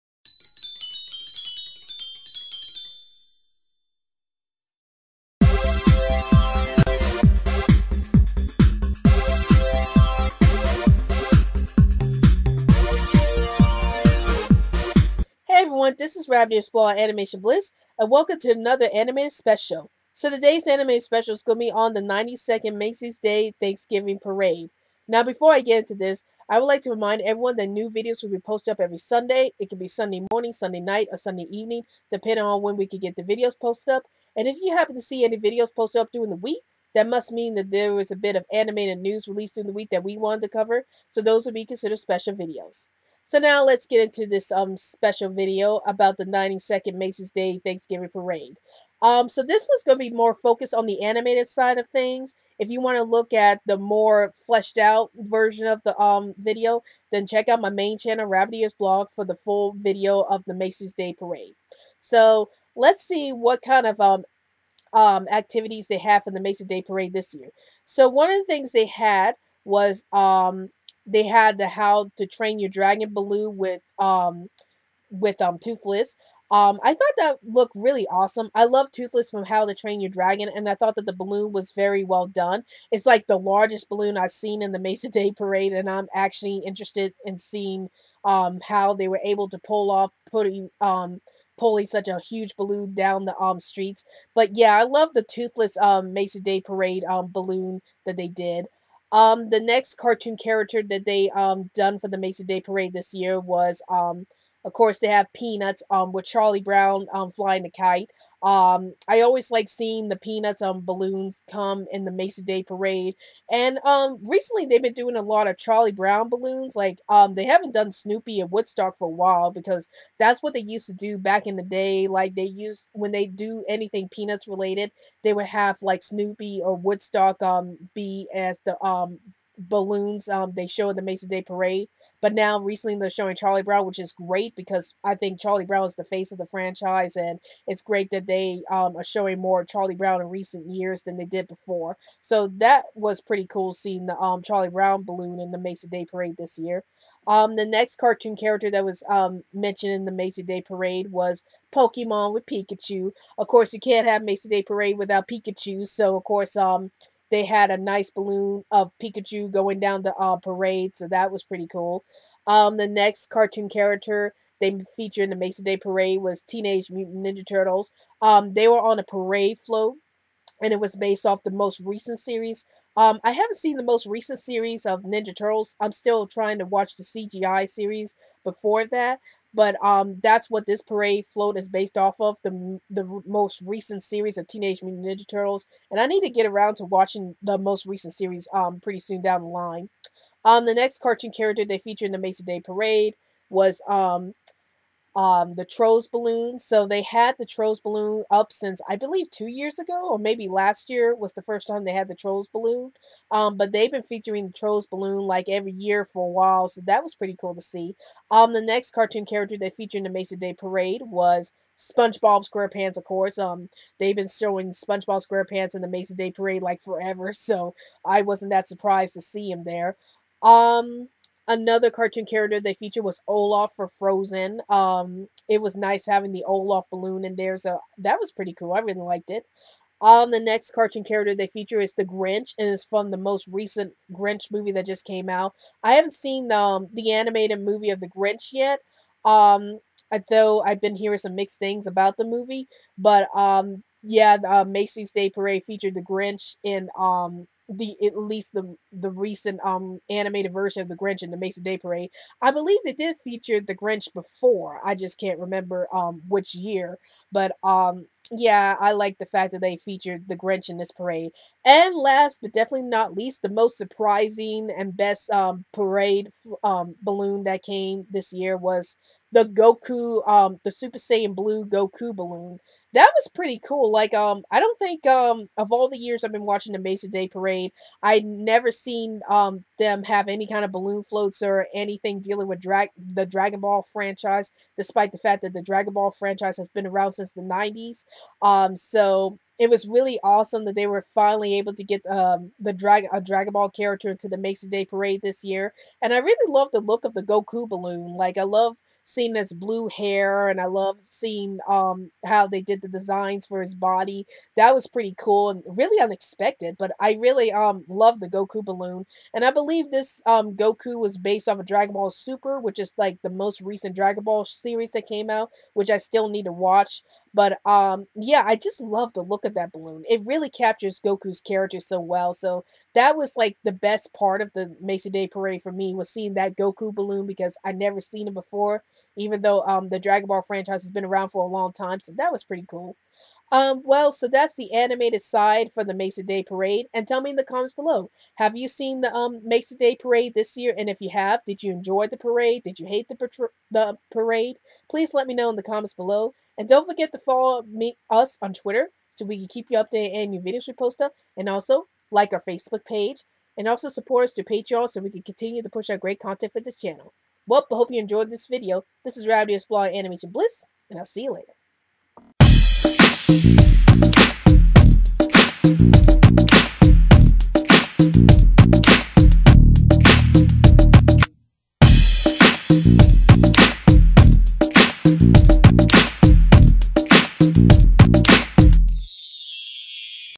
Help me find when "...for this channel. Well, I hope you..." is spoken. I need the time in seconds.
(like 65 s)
356 s.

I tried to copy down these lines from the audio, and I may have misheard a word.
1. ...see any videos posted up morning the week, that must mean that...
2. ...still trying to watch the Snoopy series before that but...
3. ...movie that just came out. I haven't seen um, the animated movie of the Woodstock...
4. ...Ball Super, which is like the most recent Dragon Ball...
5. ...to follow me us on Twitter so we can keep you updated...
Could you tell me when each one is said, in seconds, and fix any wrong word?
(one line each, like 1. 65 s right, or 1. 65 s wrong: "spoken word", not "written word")
1. 35 s wrong: "during", not "morning"
2. 175 s wrong: "CGI", not "Snoopy"
3. 234 s wrong: "Grinch", not "Woodstock"
4. 311 s right
5. 347 s right.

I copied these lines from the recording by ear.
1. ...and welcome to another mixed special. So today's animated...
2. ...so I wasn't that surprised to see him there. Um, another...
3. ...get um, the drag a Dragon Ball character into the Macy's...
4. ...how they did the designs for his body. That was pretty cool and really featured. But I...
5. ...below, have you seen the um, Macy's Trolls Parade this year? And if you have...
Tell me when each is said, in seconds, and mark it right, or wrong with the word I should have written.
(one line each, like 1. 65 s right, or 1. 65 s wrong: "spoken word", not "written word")
1. 17 s wrong: "animated", not "mixed"
2. 217 s right
3. 291 s right
4. 302 s wrong: "unexpected", not "featured"
5. 337 s wrong: "Day", not "Trolls".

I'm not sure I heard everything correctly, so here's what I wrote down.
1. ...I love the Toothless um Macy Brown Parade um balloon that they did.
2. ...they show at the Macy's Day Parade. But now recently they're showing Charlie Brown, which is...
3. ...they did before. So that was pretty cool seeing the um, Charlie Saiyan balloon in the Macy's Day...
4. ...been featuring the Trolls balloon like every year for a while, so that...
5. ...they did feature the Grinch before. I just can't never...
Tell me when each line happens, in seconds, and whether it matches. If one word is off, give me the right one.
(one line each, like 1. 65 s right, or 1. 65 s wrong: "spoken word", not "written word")
1. 94 s wrong: "Day", not "Brown"
2. 130 s right
3. 141 s wrong: "Brown", not "Saiyan"
4. 203 s right
5. 252 s wrong: "remember", not "never".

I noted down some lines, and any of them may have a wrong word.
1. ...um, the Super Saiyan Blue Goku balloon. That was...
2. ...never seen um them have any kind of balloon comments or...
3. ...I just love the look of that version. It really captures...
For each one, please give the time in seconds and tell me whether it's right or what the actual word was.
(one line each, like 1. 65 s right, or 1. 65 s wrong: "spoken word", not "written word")
1. 270 s right
2. 278 s wrong: "floats", not "comments"
3. 318 s wrong: "balloon", not "version".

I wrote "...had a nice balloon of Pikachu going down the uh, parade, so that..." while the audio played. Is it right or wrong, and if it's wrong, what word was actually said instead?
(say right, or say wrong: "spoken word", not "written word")
right.